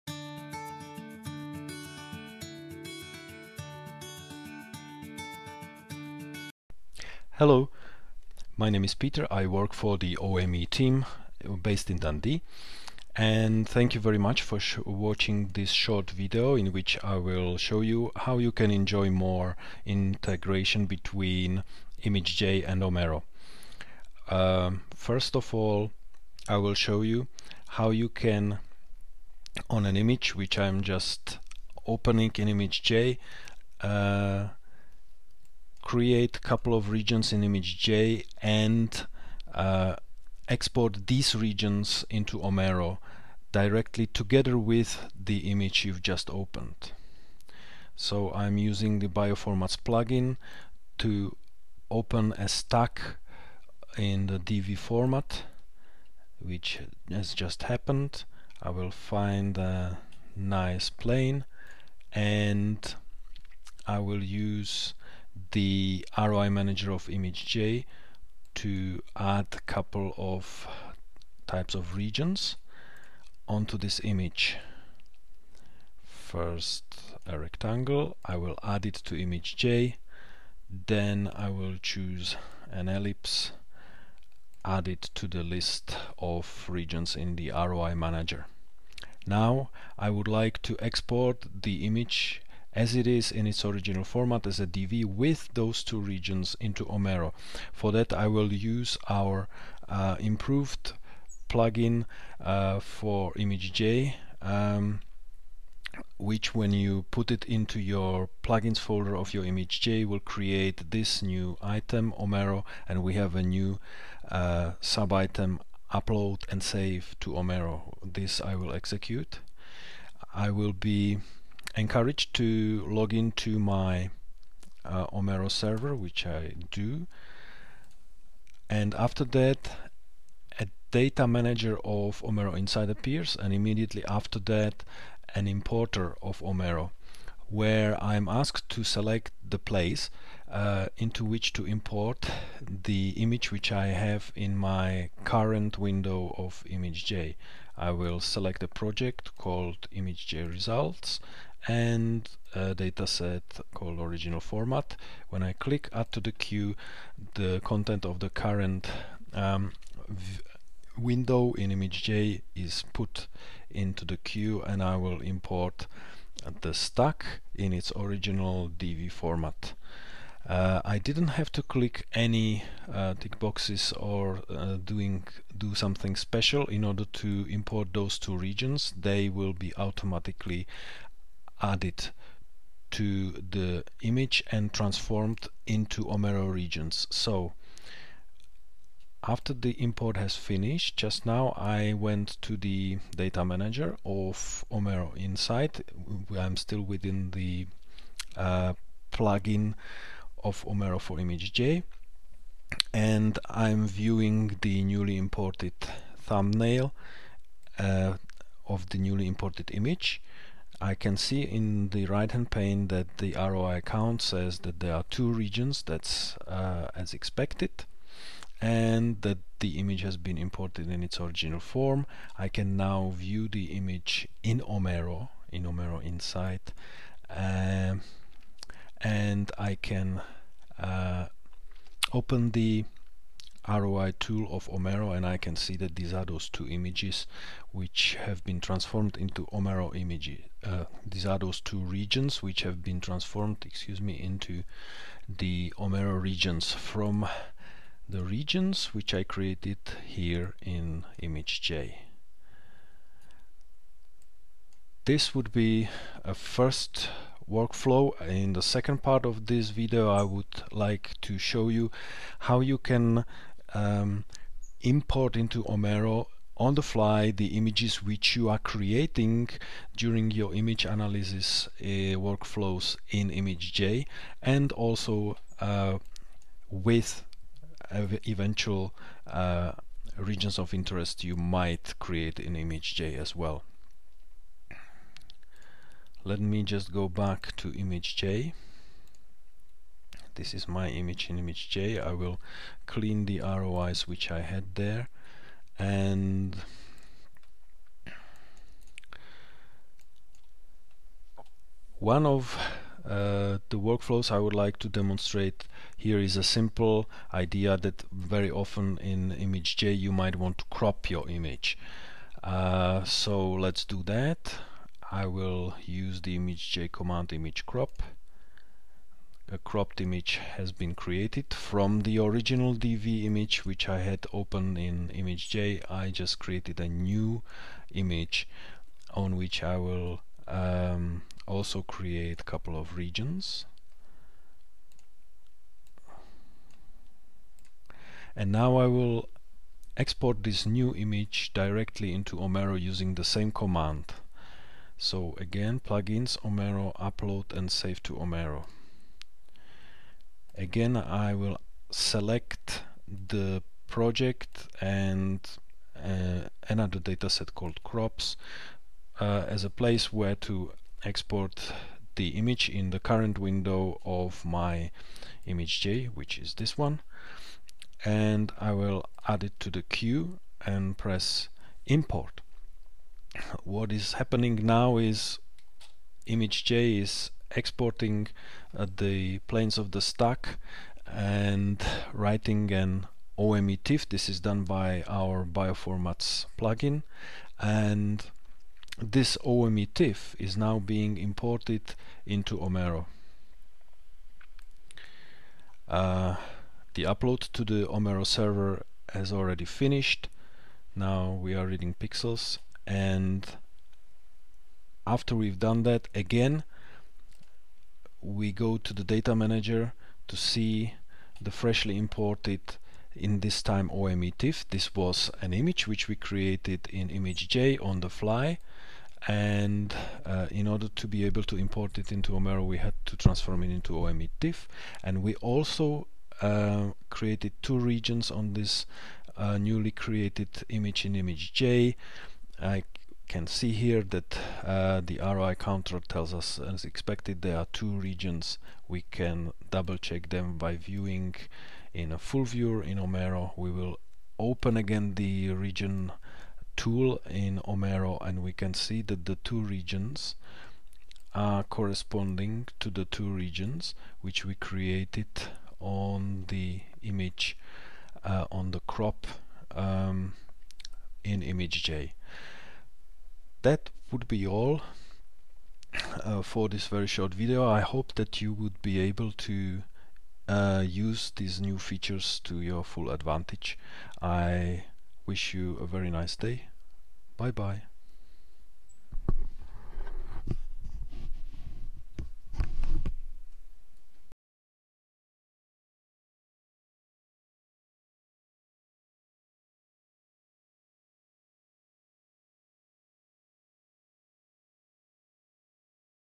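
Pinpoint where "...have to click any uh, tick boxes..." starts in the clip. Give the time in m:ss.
2:51.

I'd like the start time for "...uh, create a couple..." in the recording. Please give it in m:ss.
0:33.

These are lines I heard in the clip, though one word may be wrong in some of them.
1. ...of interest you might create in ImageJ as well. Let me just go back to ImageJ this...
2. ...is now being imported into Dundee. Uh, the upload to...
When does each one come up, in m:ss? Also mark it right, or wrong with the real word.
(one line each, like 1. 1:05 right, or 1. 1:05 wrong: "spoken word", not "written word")
1. 4:40 right
2. 6:30 wrong: "Omero", not "Dundee".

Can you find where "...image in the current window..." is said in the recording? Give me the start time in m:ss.
6:02.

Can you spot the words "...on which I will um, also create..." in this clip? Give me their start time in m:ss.
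5:29.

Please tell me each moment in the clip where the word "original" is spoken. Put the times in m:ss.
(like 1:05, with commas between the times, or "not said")
1:33, 2:33, 2:47, 3:41, 5:22.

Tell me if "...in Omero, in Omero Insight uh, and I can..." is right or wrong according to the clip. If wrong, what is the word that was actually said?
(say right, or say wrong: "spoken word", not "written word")
right.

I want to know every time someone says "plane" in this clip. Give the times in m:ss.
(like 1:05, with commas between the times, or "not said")
1:00, 6:19.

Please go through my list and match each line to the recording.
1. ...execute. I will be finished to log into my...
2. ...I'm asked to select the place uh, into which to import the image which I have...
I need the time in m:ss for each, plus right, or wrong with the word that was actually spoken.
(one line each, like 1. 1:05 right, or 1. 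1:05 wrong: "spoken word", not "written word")
1. 1:58 wrong: "encouraged", not "finished"
2. 2:18 right.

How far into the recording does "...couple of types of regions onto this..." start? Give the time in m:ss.
1:09.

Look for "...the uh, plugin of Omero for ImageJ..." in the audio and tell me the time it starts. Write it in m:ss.
3:17.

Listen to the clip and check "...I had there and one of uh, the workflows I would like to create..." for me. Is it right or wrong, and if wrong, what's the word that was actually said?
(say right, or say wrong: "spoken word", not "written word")
wrong: "demonstrate", not "create".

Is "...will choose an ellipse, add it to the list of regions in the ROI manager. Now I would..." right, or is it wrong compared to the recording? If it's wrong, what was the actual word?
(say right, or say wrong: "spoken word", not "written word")
right.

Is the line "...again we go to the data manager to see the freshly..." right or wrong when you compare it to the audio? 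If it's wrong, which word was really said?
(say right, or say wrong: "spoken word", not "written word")
right.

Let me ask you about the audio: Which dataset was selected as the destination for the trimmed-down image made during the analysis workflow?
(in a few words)
crops.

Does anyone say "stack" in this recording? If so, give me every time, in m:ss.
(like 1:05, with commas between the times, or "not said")
0:52, 2:46, 6:20.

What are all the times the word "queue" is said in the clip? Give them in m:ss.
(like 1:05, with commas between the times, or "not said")
2:36, 2:44, 6:09.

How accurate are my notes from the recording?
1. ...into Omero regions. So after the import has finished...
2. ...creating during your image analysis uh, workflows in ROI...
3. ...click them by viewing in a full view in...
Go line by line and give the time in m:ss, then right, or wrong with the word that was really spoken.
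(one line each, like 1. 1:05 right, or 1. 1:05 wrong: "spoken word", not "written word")
1. 3:05 right
2. 4:28 wrong: "ImageJ", not "ROI"
3. 7:19 wrong: "check", not "click".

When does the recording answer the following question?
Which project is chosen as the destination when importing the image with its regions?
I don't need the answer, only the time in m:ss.
2:29.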